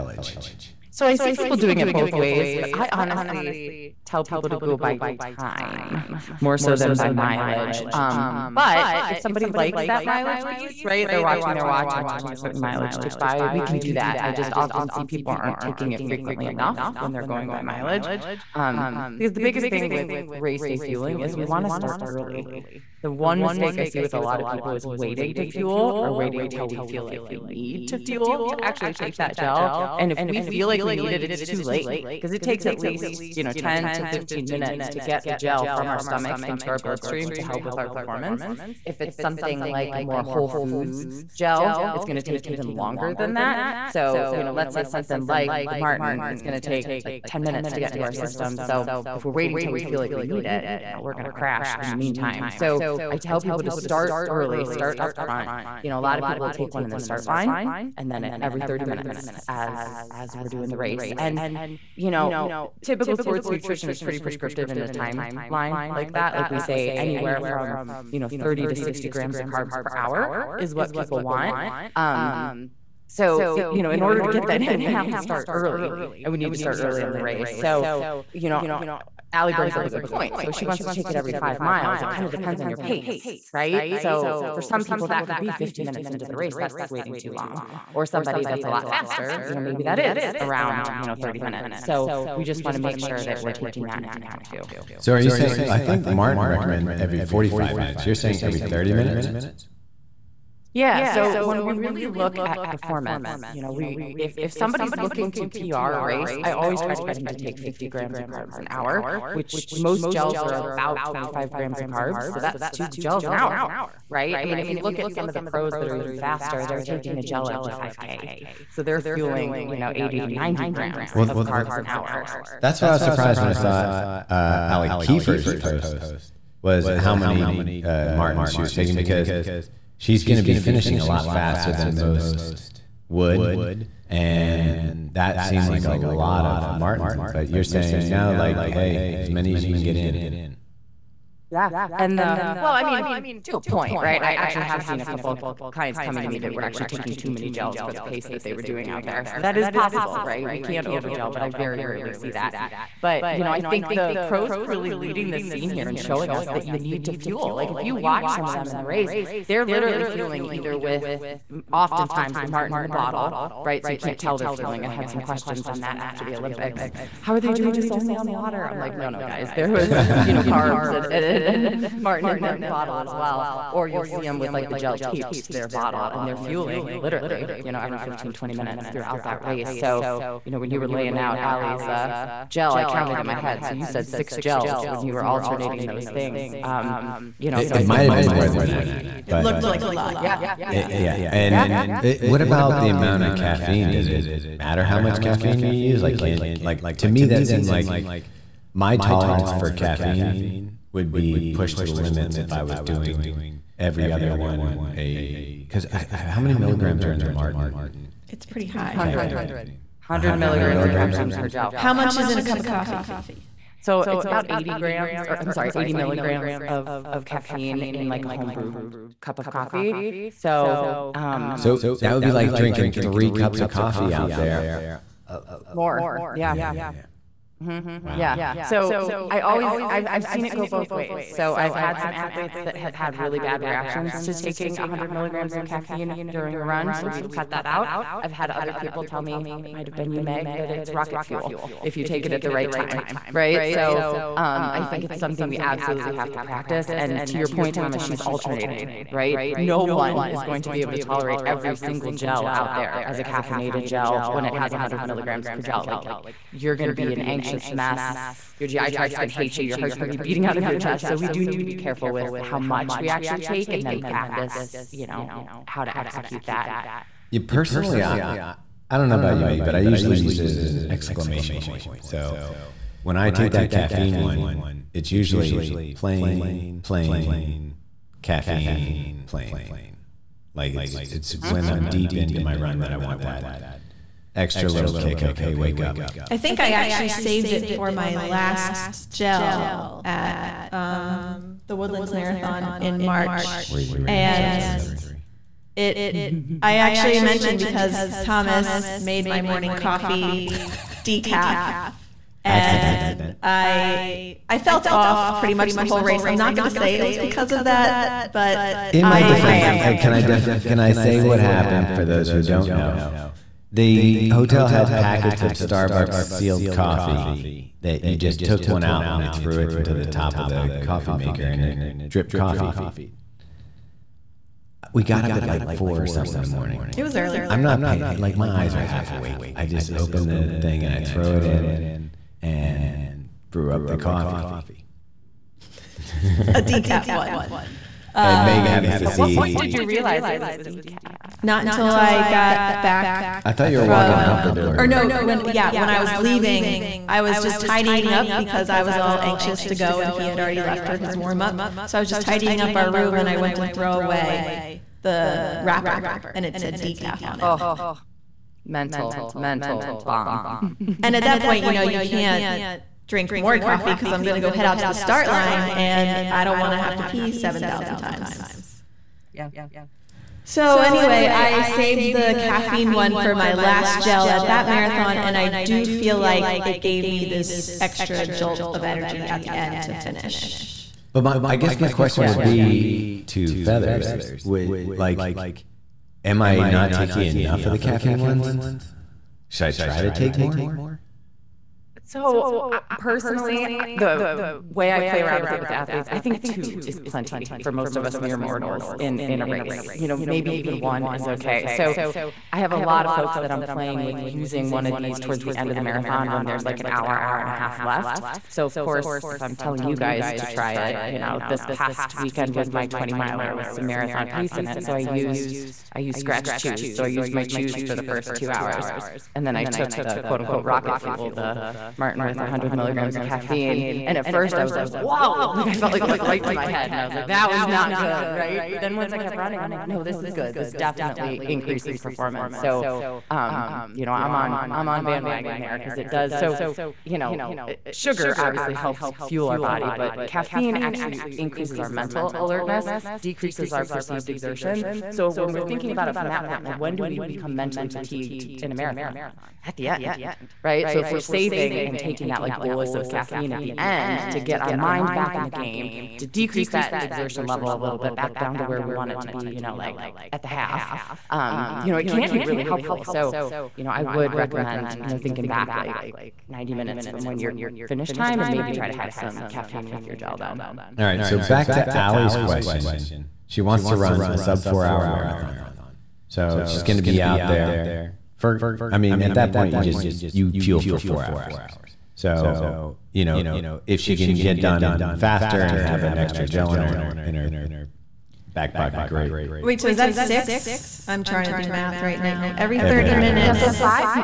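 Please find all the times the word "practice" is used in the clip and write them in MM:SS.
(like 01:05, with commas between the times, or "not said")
04:06, 04:24.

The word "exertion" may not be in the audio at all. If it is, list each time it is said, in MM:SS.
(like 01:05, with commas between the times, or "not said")
07:24, 07:37.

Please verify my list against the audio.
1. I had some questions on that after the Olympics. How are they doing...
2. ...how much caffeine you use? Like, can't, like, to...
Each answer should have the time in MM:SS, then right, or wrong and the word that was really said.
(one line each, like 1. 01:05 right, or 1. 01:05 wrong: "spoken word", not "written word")
1. 02:44 right
2. 03:14 right.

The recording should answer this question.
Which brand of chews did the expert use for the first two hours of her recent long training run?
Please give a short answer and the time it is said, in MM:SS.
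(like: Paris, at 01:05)
Skratch, at 06:56.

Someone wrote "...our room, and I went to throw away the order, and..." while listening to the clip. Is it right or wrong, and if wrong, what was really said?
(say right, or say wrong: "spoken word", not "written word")
wrong: "wrapper", not "order".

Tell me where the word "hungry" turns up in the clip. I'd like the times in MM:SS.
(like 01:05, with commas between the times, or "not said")
not said.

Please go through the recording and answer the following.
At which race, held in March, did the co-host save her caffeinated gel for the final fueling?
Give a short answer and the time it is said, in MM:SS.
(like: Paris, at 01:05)
The Woodlands Marathon, at 04:51.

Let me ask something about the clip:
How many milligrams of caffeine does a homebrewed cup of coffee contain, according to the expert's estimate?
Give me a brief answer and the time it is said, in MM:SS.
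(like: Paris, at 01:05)
80 milligrams, at 03:35.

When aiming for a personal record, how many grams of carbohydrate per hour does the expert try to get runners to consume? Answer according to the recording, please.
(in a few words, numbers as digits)
50 grams.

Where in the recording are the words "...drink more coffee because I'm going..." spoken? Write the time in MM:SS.
06:03.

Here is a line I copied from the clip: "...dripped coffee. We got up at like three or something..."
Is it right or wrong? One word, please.
wrong.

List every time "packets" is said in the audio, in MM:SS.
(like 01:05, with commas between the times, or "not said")
05:14.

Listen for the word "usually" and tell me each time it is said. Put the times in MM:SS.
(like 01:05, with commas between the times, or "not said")
04:29, 04:35.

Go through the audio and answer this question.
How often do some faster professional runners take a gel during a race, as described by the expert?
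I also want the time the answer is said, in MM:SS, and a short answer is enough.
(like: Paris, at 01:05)
Every 5K, at 01:57.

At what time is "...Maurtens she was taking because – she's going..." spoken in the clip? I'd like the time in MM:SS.
02:08.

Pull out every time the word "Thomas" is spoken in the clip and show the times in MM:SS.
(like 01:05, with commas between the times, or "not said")
04:07, 04:58.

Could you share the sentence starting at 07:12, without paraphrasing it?
So, um, you know, I'm on, I'm on bandwagon there because it does.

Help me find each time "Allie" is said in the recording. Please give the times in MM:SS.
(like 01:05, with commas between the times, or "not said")
01:19, 02:04, 03:01, 07:51.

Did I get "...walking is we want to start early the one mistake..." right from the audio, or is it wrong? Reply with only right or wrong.
wrong.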